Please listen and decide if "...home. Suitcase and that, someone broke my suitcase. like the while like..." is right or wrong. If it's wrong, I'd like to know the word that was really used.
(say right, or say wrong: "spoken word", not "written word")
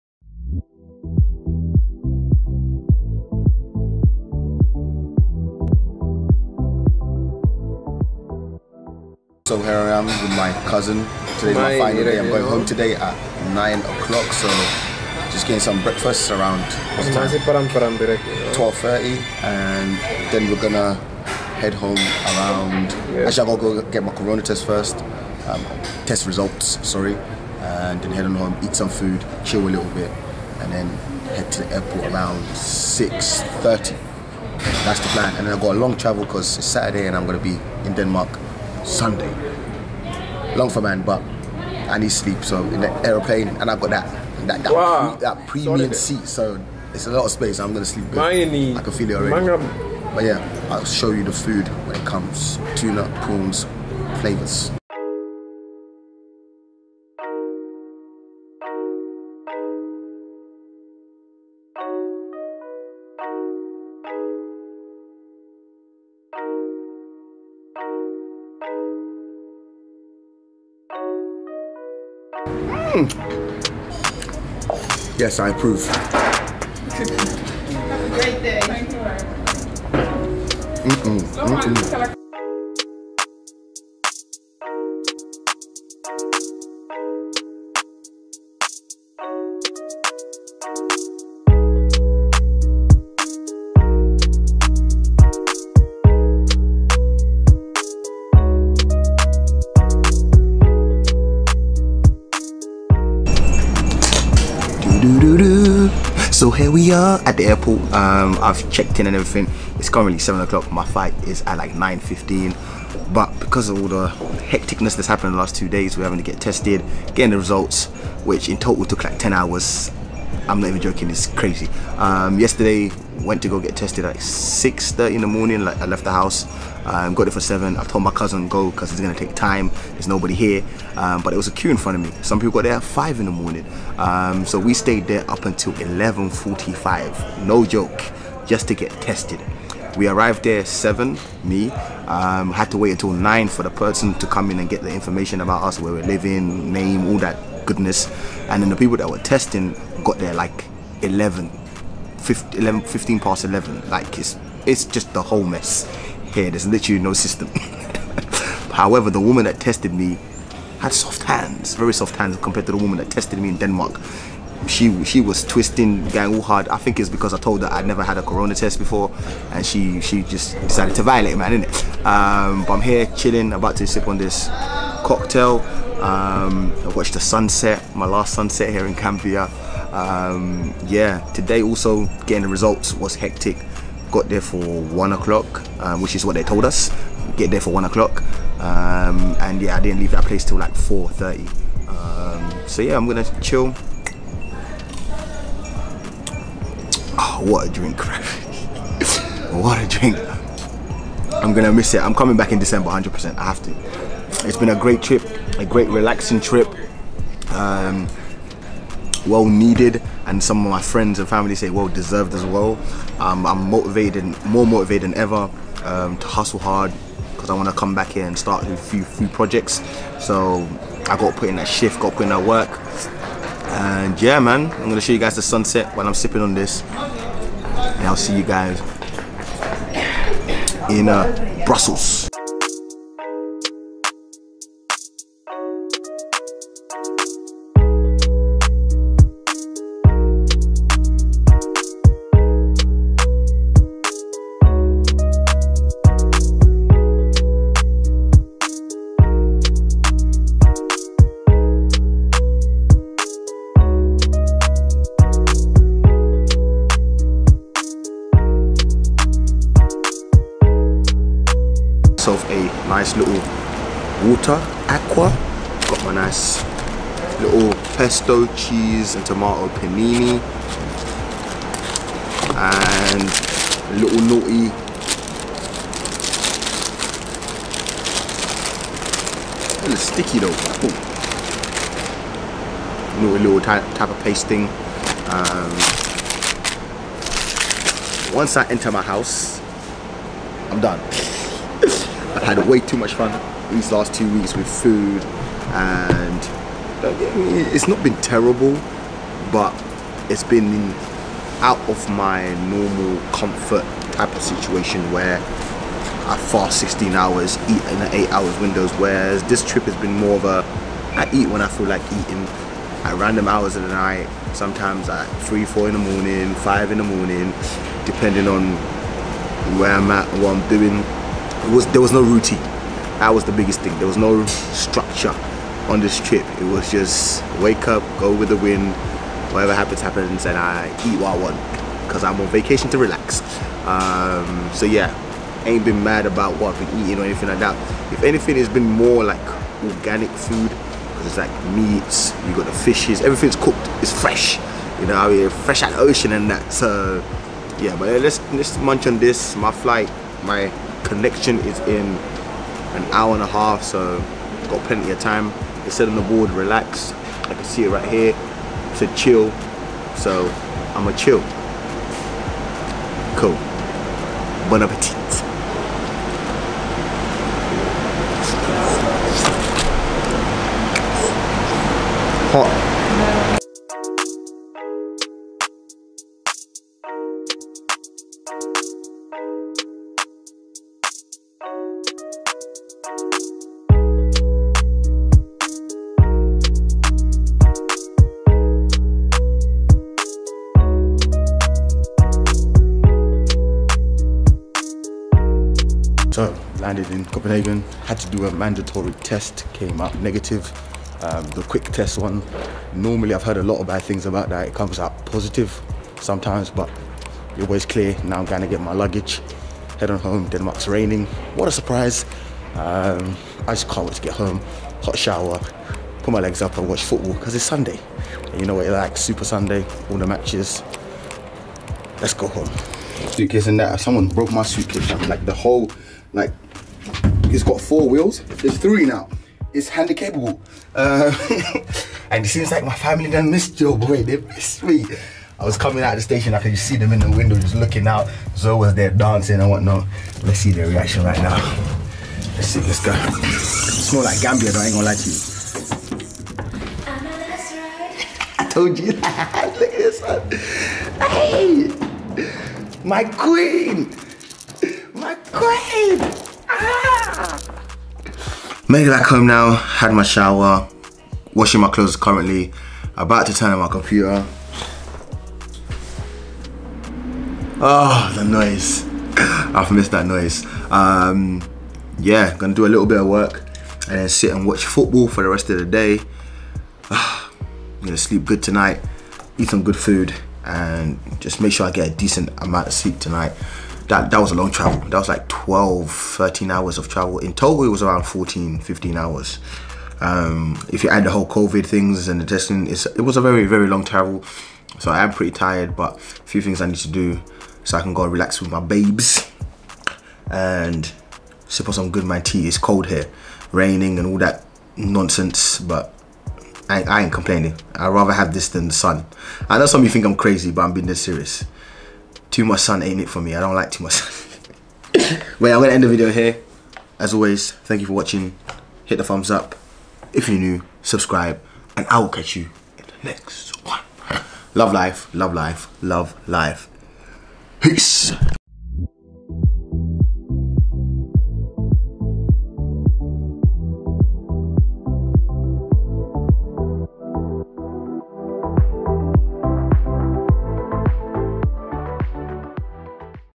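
wrong: "whole", not "while".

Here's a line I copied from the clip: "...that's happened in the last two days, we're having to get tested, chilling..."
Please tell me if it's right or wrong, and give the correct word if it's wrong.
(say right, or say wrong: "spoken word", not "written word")
wrong: "getting", not "chilling".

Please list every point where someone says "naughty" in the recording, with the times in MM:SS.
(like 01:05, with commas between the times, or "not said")
04:34.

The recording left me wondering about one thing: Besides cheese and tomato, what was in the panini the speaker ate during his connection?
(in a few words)
pesto.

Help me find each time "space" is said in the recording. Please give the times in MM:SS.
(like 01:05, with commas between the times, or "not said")
00:47.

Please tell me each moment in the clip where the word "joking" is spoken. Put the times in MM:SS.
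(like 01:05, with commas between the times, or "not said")
02:00.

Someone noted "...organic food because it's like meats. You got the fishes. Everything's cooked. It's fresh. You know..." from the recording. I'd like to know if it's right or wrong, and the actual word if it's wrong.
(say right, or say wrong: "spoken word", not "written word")
right.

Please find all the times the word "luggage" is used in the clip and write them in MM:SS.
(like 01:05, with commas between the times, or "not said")
06:48.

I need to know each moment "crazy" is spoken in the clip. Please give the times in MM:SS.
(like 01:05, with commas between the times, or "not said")
02:01, 08:30.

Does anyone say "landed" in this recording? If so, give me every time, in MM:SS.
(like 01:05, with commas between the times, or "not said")
06:36.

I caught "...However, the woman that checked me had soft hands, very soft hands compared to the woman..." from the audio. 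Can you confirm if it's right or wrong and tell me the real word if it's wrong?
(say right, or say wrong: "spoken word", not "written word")
wrong: "tested", not "checked".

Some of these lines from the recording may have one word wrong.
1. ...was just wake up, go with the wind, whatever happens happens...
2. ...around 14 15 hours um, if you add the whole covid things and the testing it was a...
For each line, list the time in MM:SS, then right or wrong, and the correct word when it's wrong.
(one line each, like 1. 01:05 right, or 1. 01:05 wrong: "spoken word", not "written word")
1. 05:26 right
2. 08:08 right.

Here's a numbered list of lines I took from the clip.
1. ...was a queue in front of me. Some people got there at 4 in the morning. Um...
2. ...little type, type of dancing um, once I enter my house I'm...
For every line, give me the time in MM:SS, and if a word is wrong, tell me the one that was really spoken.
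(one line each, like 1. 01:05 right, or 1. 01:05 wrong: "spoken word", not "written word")
1. 02:11 wrong: "5", not "4"
2. 04:43 wrong: "pasting", not "dancing".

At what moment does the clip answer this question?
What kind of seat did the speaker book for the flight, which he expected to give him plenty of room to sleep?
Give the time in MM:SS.
00:45.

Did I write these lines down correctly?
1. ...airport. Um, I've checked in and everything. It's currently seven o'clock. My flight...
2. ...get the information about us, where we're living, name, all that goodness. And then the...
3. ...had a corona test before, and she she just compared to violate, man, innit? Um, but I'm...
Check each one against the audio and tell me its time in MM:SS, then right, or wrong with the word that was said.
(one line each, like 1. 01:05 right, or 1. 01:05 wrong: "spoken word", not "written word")
1. 01:47 right
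2. 02:24 right
3. 02:48 wrong: "decided", not "compared".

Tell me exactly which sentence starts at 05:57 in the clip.
I can see it right here.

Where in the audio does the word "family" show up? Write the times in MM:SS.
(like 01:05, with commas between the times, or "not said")
03:31, 07:12.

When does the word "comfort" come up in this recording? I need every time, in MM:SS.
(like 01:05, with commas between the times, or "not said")
05:03.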